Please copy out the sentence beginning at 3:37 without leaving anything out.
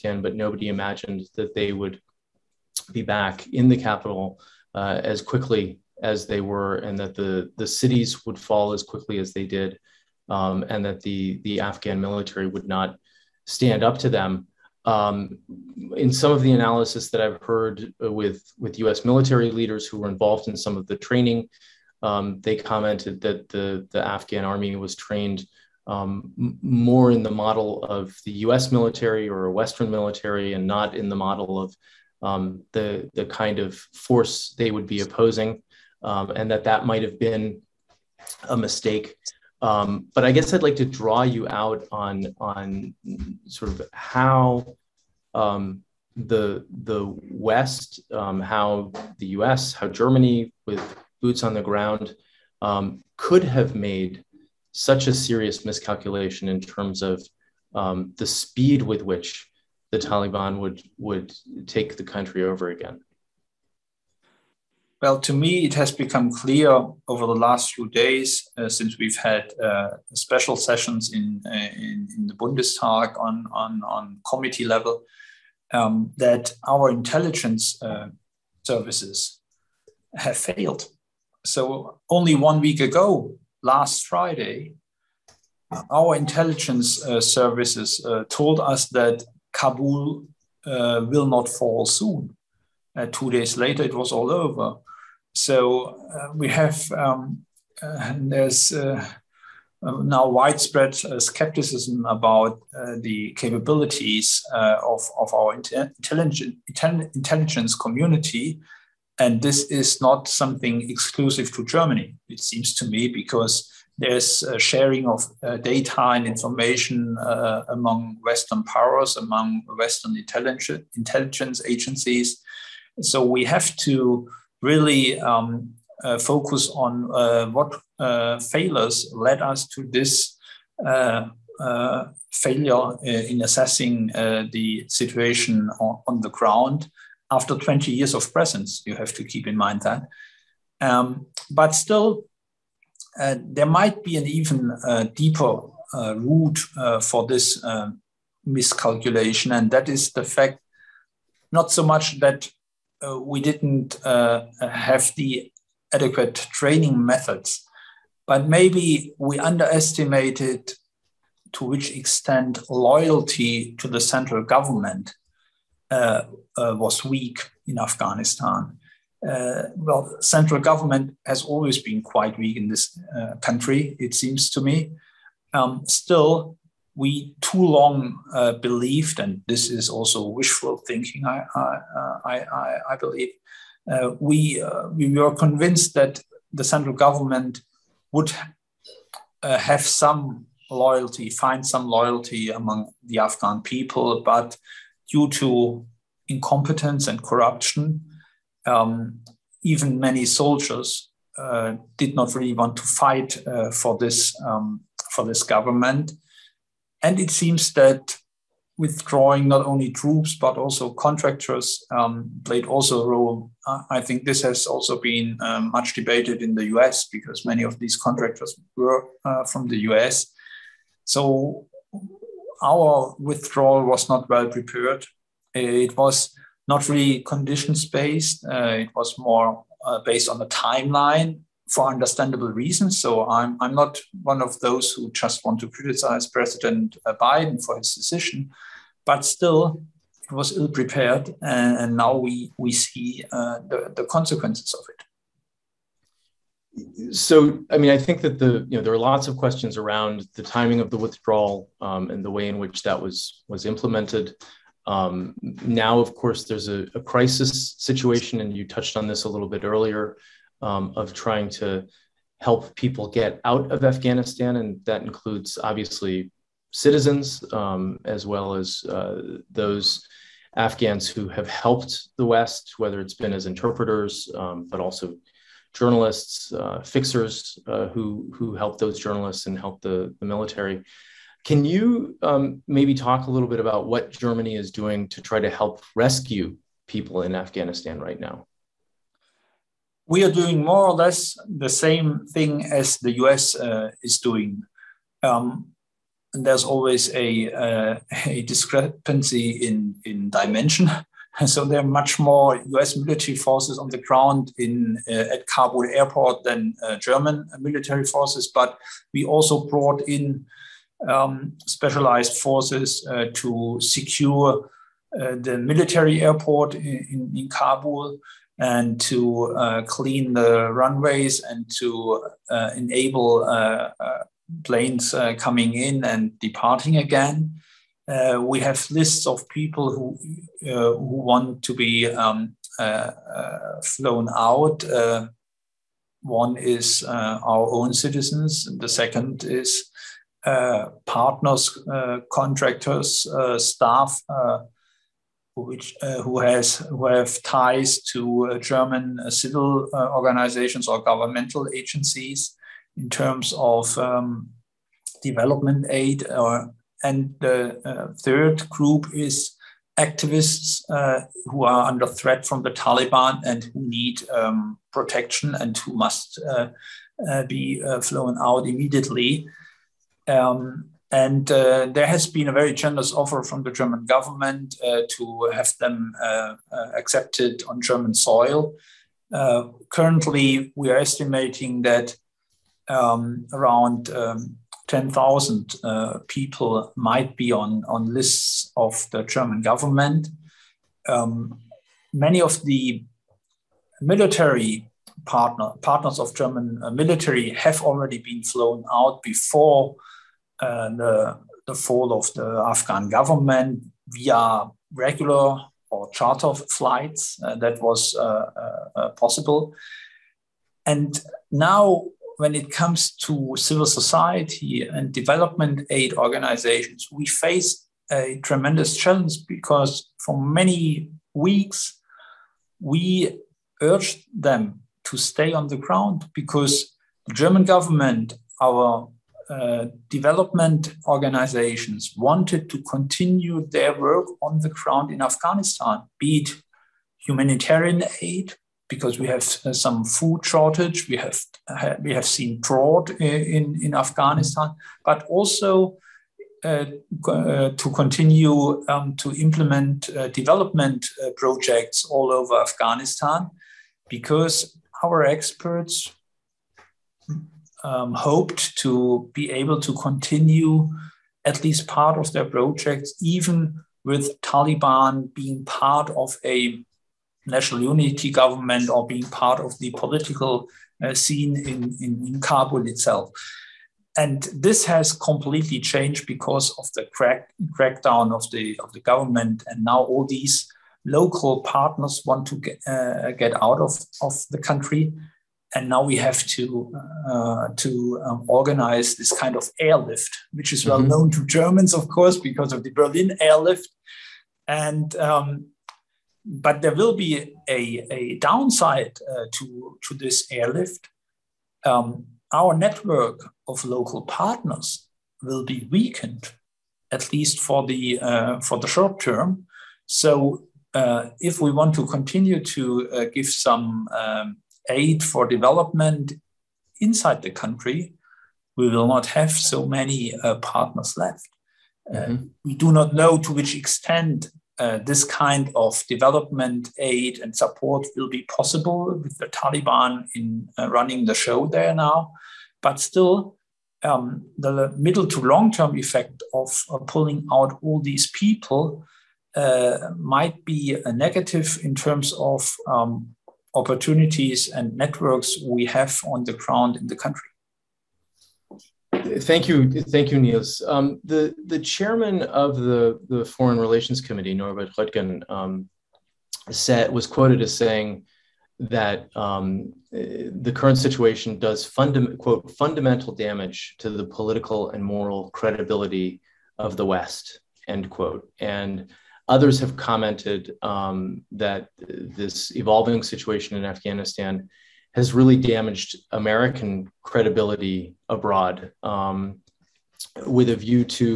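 because many of these contractors were uh, from the U.S.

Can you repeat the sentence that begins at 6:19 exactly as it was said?
Uh, currently, we are estimating that um, around um, 10,000 uh, people might be on, on lists of the German government.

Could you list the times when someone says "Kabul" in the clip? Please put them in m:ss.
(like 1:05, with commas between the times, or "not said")
1:29, 5:05, 5:17, 7:52.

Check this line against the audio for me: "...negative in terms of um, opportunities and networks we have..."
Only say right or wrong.
right.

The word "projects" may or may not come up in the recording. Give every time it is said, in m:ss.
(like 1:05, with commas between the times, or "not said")
7:31, 7:42.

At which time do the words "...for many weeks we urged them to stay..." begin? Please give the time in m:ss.
7:00.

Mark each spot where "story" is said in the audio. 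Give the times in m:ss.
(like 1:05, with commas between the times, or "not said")
not said.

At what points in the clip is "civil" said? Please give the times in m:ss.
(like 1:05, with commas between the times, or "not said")
5:49, 6:53.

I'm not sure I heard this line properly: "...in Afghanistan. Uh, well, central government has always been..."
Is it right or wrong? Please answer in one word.
right.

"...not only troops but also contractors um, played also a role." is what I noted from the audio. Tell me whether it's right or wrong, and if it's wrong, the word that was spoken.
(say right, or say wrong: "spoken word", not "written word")
right.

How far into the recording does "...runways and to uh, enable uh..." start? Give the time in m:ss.
5:20.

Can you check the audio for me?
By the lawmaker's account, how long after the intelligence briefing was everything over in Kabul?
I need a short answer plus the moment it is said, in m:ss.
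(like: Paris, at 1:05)
2 days, at 1:33.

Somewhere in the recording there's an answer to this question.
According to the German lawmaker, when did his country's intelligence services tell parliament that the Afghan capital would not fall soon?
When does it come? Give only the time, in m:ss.
1:23.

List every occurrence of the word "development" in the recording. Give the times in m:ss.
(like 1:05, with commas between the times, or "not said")
5:55, 6:55, 7:10, 7:30, 8:35, 8:46.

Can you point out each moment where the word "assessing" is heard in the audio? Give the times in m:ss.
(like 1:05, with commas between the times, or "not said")
2:13.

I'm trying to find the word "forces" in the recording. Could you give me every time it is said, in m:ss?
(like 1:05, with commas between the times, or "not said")
0:33, 5:03, 5:08, 5:12.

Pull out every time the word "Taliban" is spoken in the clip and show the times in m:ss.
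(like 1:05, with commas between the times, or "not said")
0:59, 6:02, 7:44, 8:49.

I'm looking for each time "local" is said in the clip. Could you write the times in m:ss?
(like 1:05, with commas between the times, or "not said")
8:01, 8:23.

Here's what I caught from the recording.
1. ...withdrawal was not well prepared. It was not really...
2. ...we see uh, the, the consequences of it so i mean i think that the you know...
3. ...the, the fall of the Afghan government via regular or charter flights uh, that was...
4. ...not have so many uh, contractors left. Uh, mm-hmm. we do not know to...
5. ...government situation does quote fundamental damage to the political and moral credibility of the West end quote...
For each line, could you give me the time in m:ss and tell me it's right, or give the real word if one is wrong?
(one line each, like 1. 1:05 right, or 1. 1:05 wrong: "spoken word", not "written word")
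1. 3:43 right
2. 4:02 right
3. 6:40 right
4. 8:39 wrong: "partners", not "contractors"
5. 9:20 wrong: "current", not "government".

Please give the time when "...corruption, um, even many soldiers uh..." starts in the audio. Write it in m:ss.
3:17.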